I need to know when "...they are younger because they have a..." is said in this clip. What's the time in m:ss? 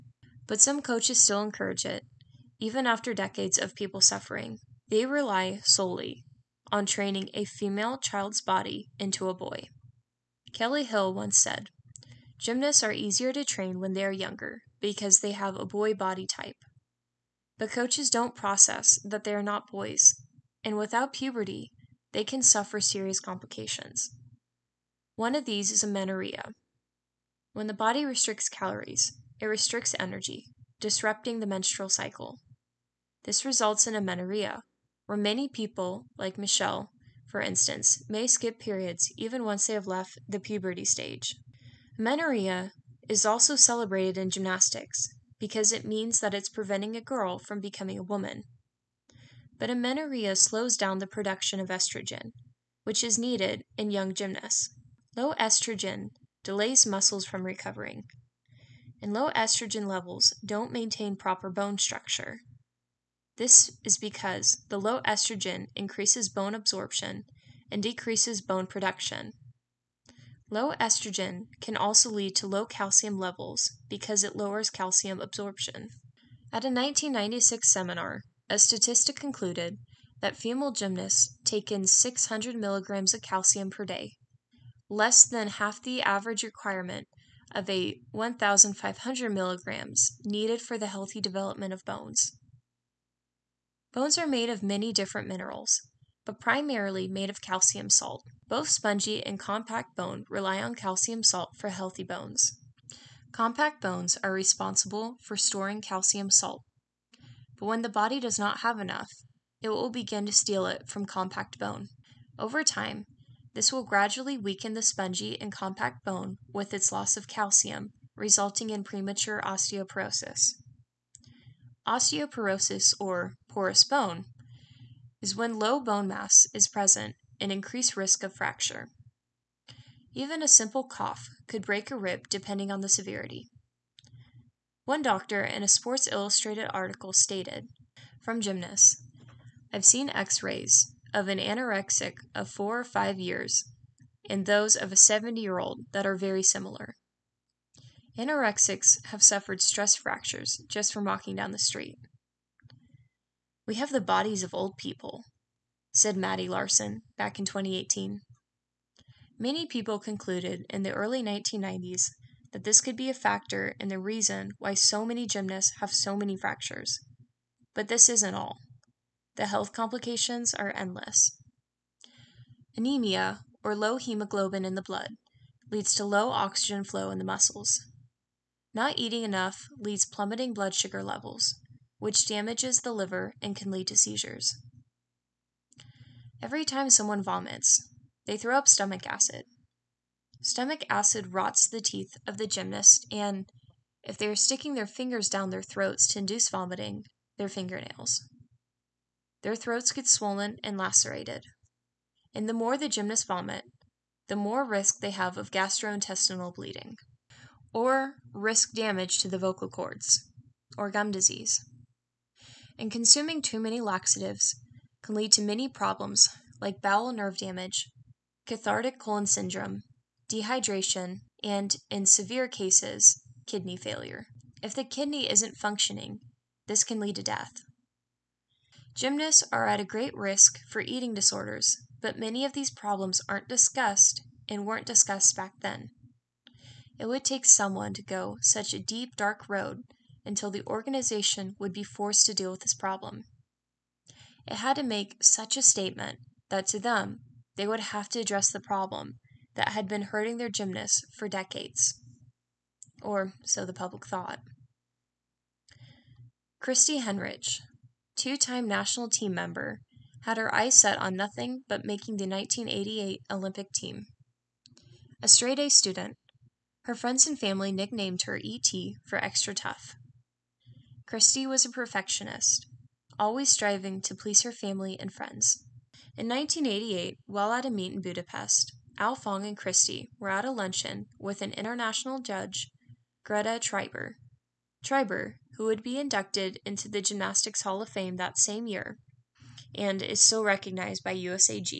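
0:13.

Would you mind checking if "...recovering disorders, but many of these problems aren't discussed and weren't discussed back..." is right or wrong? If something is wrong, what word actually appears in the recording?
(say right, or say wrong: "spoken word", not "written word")
wrong: "eating", not "recovering".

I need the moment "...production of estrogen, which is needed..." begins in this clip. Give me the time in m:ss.
0:51.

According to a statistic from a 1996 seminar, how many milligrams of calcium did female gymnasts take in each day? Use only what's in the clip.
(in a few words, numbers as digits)
600 milligrams.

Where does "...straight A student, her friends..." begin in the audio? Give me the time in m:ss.
4:25.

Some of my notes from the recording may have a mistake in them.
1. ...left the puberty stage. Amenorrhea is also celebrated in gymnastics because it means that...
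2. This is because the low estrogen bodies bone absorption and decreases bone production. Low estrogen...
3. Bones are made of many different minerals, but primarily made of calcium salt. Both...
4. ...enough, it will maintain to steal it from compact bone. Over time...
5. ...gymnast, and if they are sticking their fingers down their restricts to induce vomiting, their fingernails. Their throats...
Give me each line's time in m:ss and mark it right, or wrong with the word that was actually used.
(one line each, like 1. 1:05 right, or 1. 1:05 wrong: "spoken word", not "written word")
1. 0:39 right
2. 1:03 wrong: "increases", not "bodies"
3. 1:33 right
4. 1:48 wrong: "begin", not "maintain"
5. 3:12 wrong: "throats", not "restricts".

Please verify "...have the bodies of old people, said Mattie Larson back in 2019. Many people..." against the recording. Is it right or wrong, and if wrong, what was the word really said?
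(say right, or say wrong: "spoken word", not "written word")
wrong: "2018", not "2019".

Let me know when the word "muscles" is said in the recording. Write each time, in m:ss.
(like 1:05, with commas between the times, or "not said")
0:56, 2:57.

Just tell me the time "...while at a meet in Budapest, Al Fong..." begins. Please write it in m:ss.
4:37.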